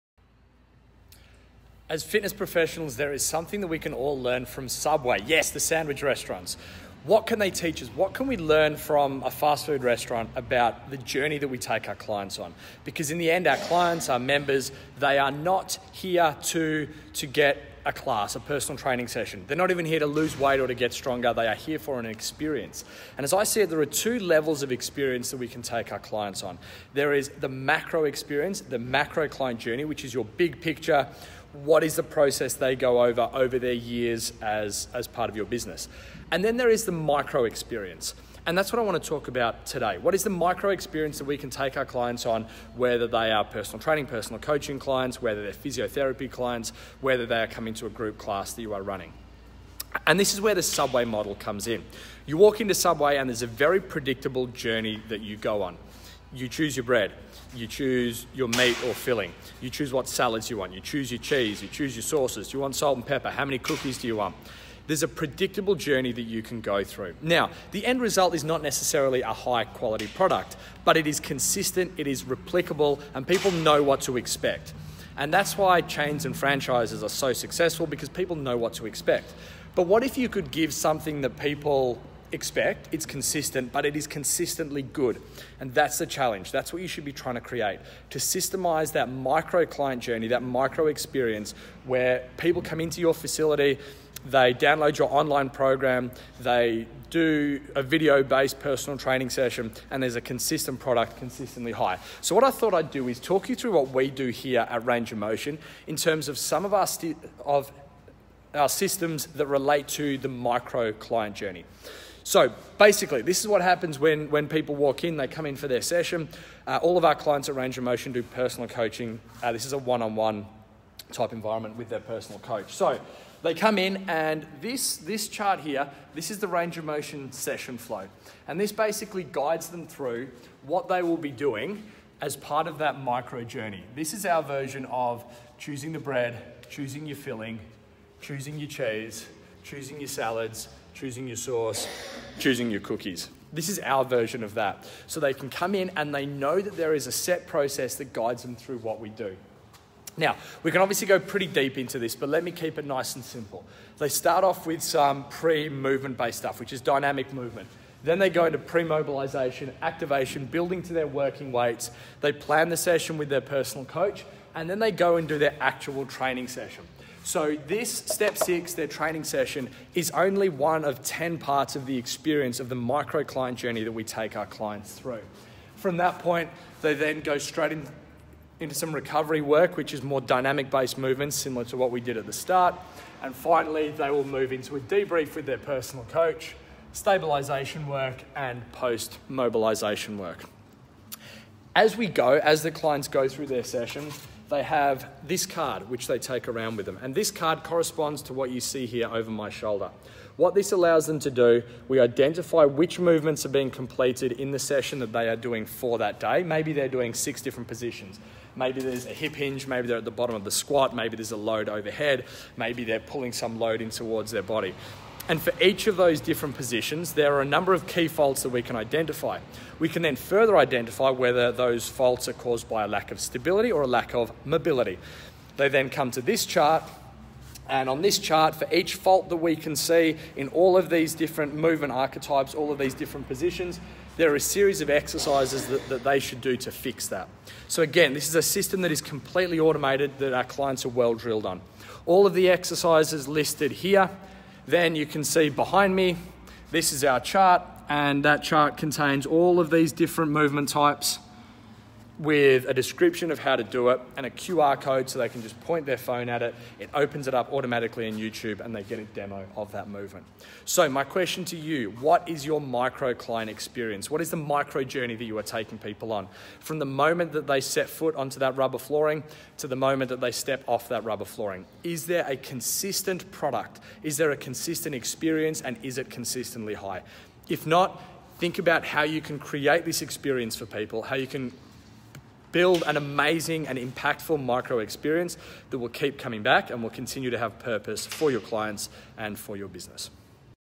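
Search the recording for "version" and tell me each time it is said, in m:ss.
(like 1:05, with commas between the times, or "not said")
2:14, 2:24.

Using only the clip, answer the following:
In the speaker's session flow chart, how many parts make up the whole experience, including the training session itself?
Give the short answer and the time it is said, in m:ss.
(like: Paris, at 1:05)
10, at 2:51.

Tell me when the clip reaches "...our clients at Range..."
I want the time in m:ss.
1:57.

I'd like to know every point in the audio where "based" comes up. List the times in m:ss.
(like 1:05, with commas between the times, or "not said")
1:38, 2:36, 3:00.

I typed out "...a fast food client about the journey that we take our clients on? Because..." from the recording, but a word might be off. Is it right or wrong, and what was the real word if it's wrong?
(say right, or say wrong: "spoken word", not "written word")
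wrong: "restaurant", not "client".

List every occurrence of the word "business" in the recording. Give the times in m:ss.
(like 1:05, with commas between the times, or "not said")
0:35, 4:49.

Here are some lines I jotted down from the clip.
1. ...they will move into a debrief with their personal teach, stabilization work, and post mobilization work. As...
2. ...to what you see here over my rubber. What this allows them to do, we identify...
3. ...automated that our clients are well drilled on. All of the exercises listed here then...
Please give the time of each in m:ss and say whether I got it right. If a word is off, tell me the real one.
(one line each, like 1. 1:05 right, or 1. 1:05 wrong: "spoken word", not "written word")
1. 3:03 wrong: "coach", not "teach"
2. 3:18 wrong: "shoulder", not "rubber"
3. 3:59 right.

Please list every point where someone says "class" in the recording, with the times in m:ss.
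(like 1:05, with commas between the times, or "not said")
0:17, 0:48.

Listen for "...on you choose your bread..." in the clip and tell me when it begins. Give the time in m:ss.
0:55.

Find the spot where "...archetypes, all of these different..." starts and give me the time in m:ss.
3:51.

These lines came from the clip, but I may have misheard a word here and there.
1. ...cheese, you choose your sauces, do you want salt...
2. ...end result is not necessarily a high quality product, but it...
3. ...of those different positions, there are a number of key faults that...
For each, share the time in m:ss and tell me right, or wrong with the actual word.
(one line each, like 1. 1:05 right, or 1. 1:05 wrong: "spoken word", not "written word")
1. 1:01 right
2. 1:07 right
3. 3:35 right.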